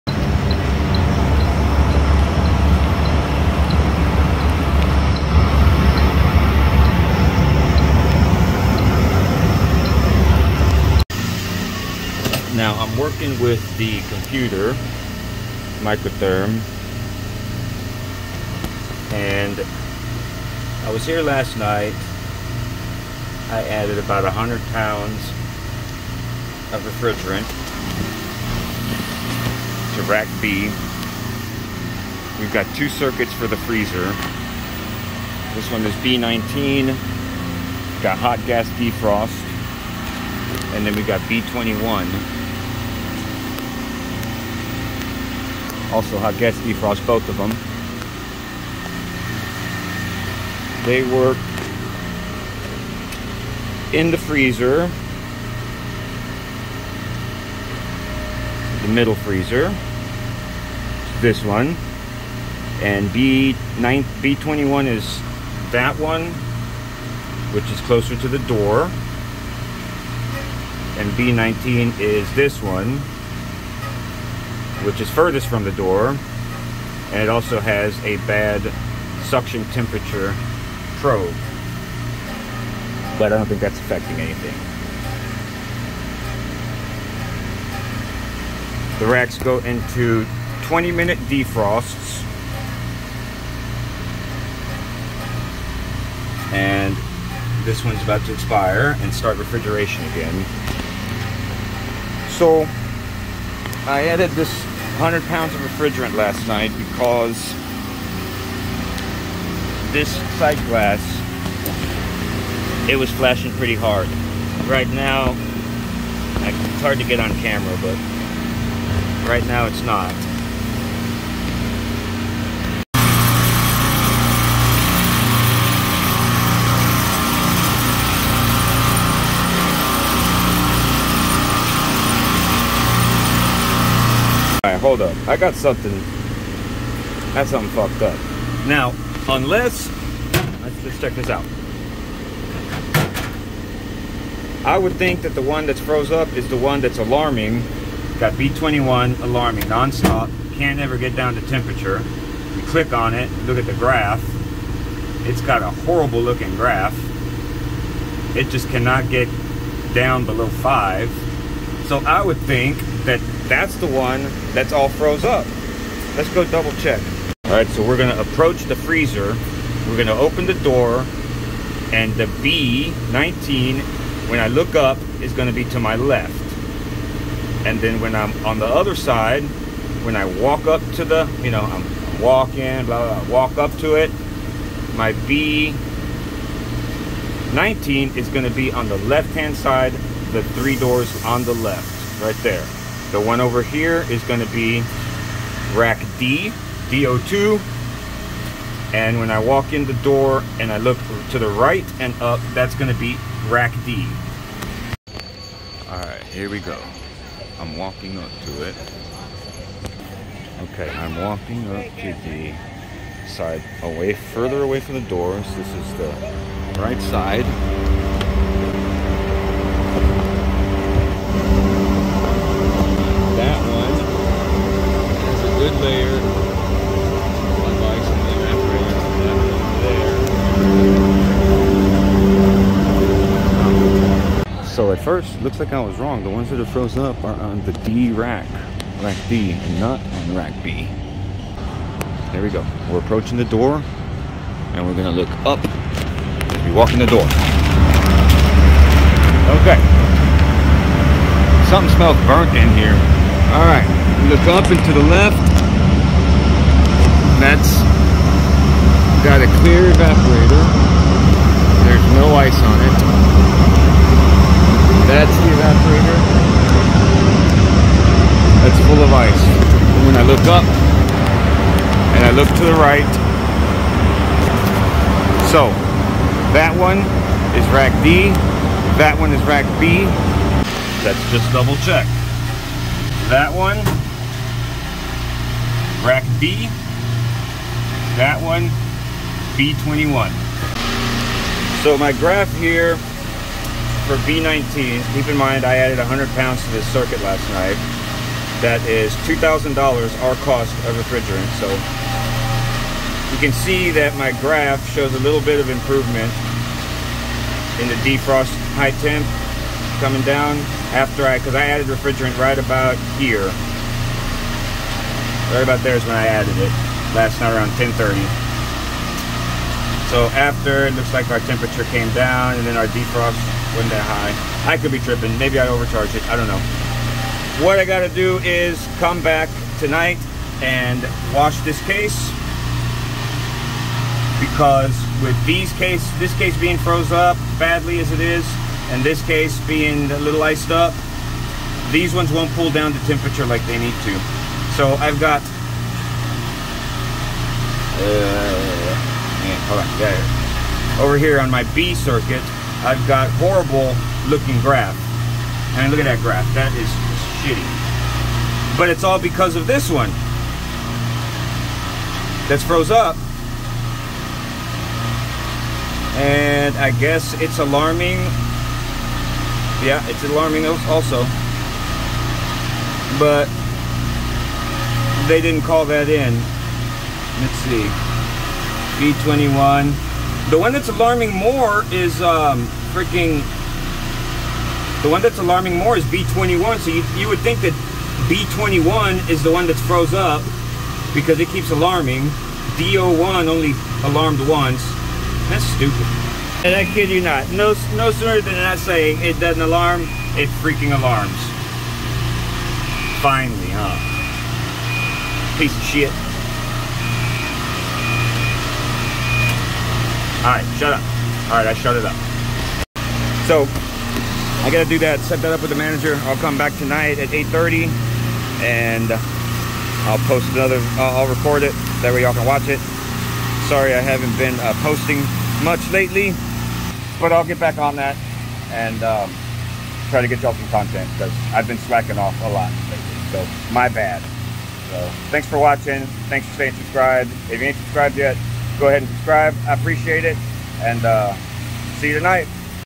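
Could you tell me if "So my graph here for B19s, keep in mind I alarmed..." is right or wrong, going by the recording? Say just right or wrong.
wrong.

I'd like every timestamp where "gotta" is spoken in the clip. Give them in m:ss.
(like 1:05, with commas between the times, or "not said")
5:27, 6:54.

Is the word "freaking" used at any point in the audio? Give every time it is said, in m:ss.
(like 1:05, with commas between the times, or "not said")
6:22, 6:40.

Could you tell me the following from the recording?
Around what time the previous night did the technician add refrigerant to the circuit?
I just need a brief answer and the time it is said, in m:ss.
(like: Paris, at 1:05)
10:30, at 5:17.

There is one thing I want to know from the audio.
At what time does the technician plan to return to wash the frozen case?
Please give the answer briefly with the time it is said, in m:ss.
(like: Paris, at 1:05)
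8:30, at 6:57.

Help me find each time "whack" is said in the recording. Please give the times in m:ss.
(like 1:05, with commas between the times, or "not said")
not said.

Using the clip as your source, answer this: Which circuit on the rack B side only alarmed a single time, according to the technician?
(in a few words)
DO1.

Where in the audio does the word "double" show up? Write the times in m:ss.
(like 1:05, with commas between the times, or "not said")
2:46, 4:41.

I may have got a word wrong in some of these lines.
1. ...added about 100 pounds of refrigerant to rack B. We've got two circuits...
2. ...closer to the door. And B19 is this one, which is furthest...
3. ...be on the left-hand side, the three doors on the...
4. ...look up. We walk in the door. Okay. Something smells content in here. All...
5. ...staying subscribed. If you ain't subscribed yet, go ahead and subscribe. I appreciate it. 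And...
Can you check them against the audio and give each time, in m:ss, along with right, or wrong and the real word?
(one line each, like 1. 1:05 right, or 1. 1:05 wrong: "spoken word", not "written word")
1. 0:23 right
2. 1:07 right
3. 3:08 right
4. 4:05 wrong: "burnt", not "content"
5. 7:16 right.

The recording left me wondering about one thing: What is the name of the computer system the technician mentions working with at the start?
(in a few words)
Microtherm.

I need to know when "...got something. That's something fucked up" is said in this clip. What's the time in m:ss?
2:15.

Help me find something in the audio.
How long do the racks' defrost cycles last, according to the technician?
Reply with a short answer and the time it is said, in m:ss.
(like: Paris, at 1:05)
20 minutes, at 1:30.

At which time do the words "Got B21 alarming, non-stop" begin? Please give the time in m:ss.
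2:28.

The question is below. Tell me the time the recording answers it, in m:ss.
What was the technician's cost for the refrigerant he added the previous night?
4:59.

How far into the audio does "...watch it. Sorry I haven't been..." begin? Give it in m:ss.
7:02.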